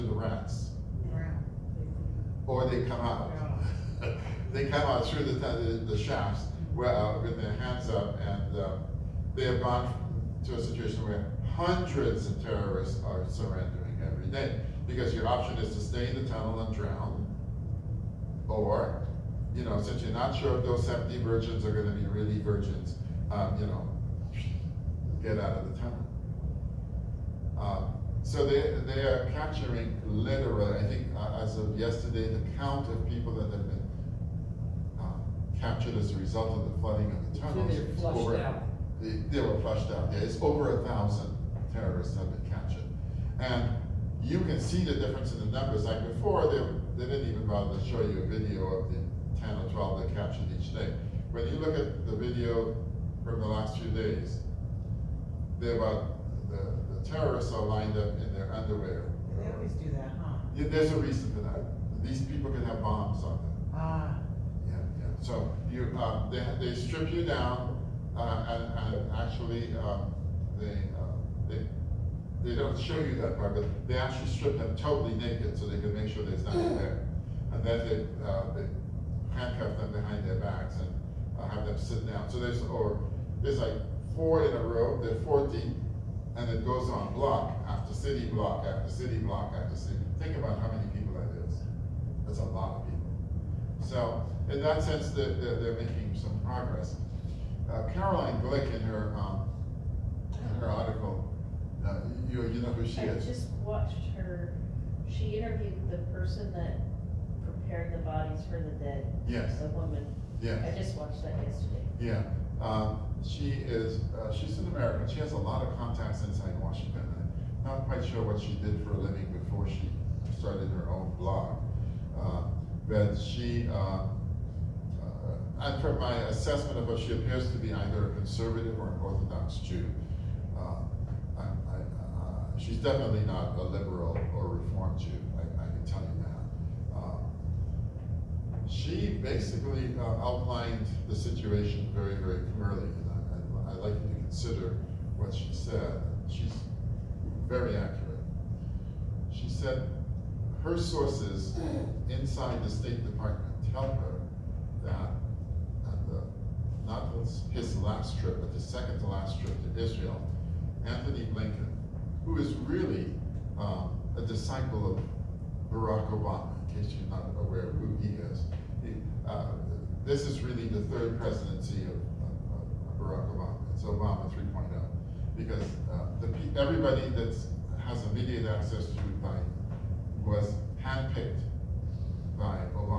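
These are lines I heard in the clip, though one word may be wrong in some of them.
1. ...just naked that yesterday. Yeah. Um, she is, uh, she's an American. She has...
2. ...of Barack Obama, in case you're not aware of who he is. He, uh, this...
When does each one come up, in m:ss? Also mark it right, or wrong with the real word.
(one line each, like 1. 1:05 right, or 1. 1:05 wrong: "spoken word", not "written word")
1. 1:50 wrong: "watched", not "naked"
2. 2:44 right.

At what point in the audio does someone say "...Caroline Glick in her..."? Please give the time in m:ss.
1:37.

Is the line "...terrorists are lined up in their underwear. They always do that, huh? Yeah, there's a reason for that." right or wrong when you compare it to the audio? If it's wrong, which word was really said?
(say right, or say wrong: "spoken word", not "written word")
right.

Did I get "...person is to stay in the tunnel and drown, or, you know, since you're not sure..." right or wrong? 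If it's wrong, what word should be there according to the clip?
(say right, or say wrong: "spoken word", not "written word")
wrong: "option", not "person".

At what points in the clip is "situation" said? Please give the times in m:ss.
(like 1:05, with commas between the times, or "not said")
0:10, 2:21.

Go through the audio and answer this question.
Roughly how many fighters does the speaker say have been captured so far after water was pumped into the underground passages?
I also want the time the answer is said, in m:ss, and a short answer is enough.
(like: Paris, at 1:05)
over 1000, at 0:40.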